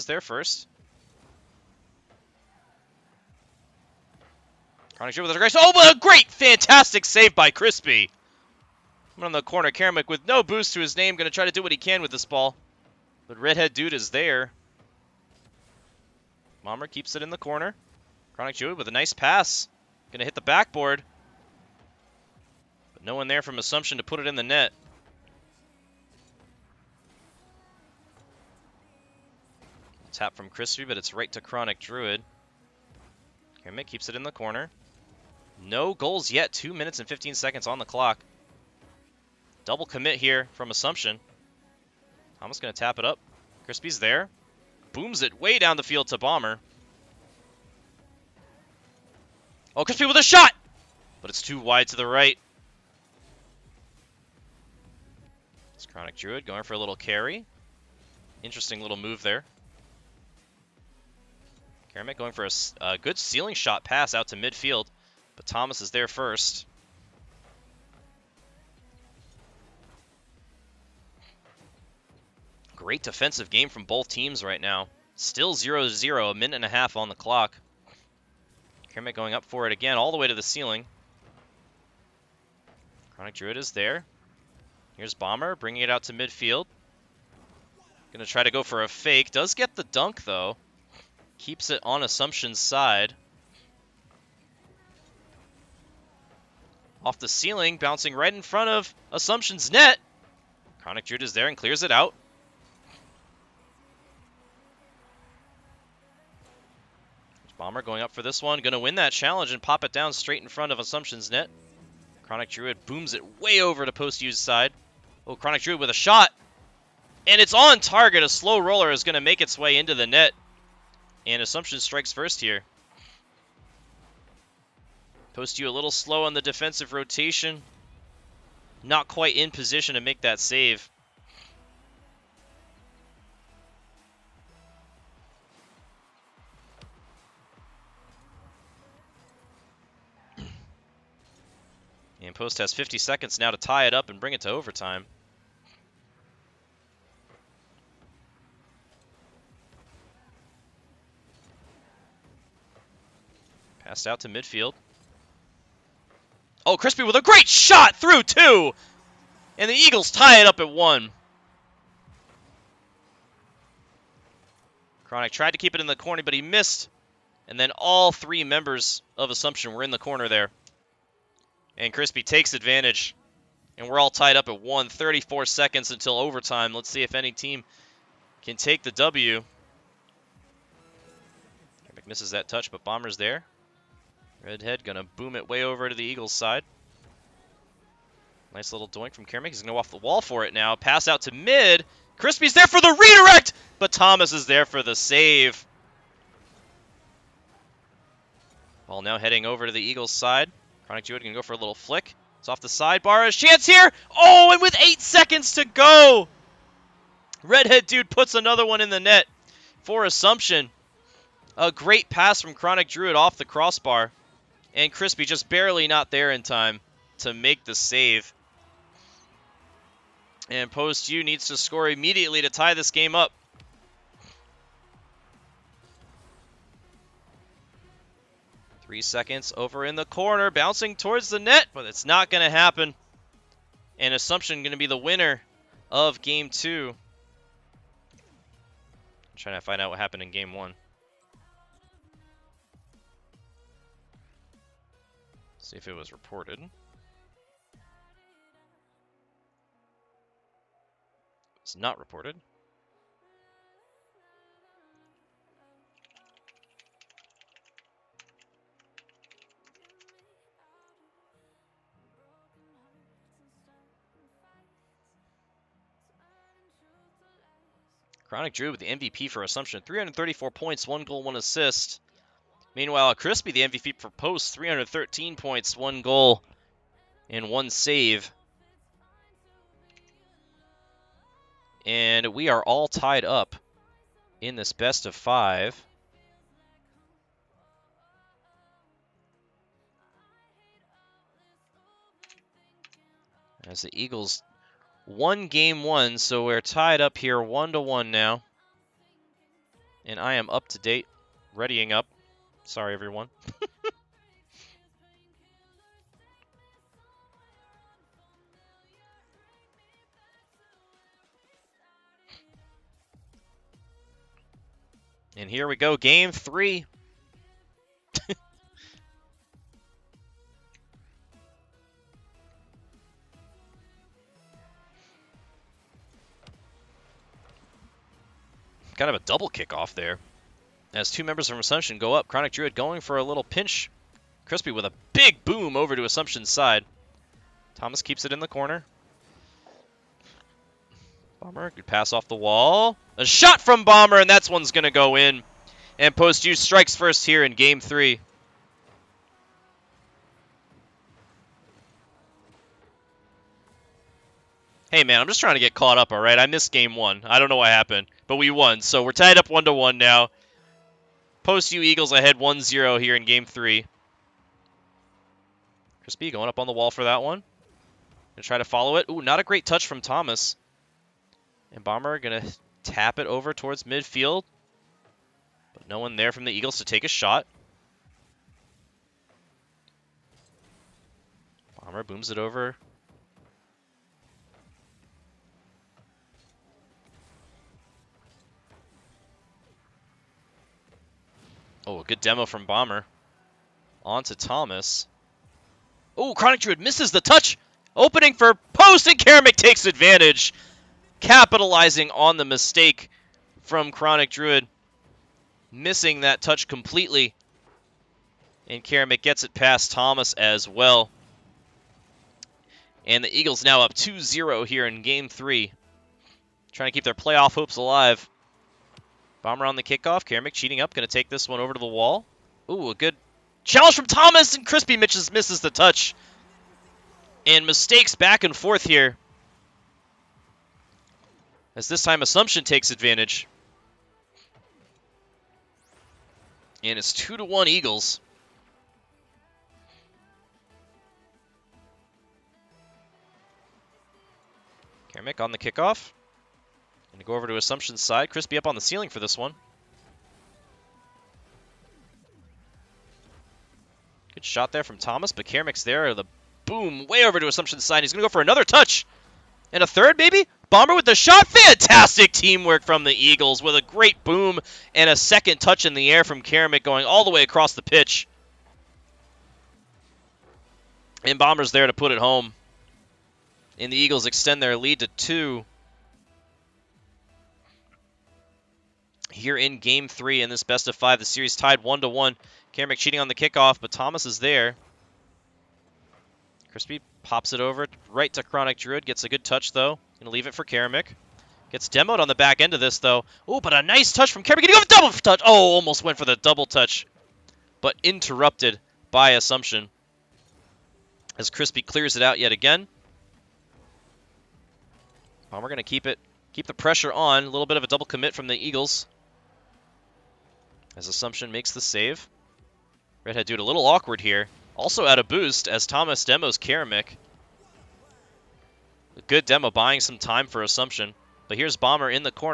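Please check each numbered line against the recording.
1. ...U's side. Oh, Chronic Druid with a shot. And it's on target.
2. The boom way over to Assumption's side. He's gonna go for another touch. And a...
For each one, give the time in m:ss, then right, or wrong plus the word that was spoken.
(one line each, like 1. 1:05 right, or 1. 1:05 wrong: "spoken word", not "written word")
1. 1:54 right
2. 7:36 right.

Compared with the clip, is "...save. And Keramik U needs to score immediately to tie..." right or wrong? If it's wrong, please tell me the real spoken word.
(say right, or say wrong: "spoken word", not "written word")
wrong: "Post", not "Keramik".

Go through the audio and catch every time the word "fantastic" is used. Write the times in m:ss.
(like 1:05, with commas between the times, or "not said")
0:06, 7:41.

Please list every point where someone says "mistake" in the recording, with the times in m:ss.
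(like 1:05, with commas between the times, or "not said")
6:42, 7:07.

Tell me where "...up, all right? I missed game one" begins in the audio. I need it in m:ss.
5:55.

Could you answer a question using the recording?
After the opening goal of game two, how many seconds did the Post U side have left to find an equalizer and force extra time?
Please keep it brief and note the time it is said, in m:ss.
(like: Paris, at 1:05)
50, at 2:22.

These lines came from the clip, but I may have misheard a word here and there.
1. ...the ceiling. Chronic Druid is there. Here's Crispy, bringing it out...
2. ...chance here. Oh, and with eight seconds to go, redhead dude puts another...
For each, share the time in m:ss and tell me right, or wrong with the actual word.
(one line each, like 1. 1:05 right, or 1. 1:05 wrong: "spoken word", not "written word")
1. 1:20 wrong: "Bomber", not "Crispy"
2. 3:23 right.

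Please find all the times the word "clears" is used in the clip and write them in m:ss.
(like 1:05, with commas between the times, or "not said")
1:41, 8:21.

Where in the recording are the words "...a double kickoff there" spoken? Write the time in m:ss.
5:29.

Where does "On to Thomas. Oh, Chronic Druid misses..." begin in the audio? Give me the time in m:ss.
6:34.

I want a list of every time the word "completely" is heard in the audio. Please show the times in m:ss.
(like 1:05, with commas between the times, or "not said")
6:46.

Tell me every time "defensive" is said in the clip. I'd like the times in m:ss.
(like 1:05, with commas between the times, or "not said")
1:13, 2:06.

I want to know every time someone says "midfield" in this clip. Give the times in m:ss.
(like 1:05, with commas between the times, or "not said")
1:04, 1:26, 2:34, 6:13.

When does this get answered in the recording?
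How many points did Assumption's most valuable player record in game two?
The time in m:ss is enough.
4:29.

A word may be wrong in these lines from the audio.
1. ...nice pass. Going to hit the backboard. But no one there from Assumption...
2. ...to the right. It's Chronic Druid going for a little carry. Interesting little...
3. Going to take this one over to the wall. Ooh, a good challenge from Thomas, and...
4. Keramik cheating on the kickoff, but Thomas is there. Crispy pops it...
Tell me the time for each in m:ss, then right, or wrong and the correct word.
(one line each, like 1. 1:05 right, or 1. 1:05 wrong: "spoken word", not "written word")
1. 0:18 right
2. 0:51 right
3. 7:00 right
4. 8:02 right.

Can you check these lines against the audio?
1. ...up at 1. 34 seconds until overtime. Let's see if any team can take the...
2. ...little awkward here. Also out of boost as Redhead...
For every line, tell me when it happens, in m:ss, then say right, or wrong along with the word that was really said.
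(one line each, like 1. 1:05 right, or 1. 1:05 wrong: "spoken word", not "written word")
1. 2:54 right
2. 8:33 wrong: "Thomas", not "Redhead".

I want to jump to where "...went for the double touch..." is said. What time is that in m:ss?
8:16.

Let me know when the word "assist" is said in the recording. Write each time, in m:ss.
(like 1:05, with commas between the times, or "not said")
4:31.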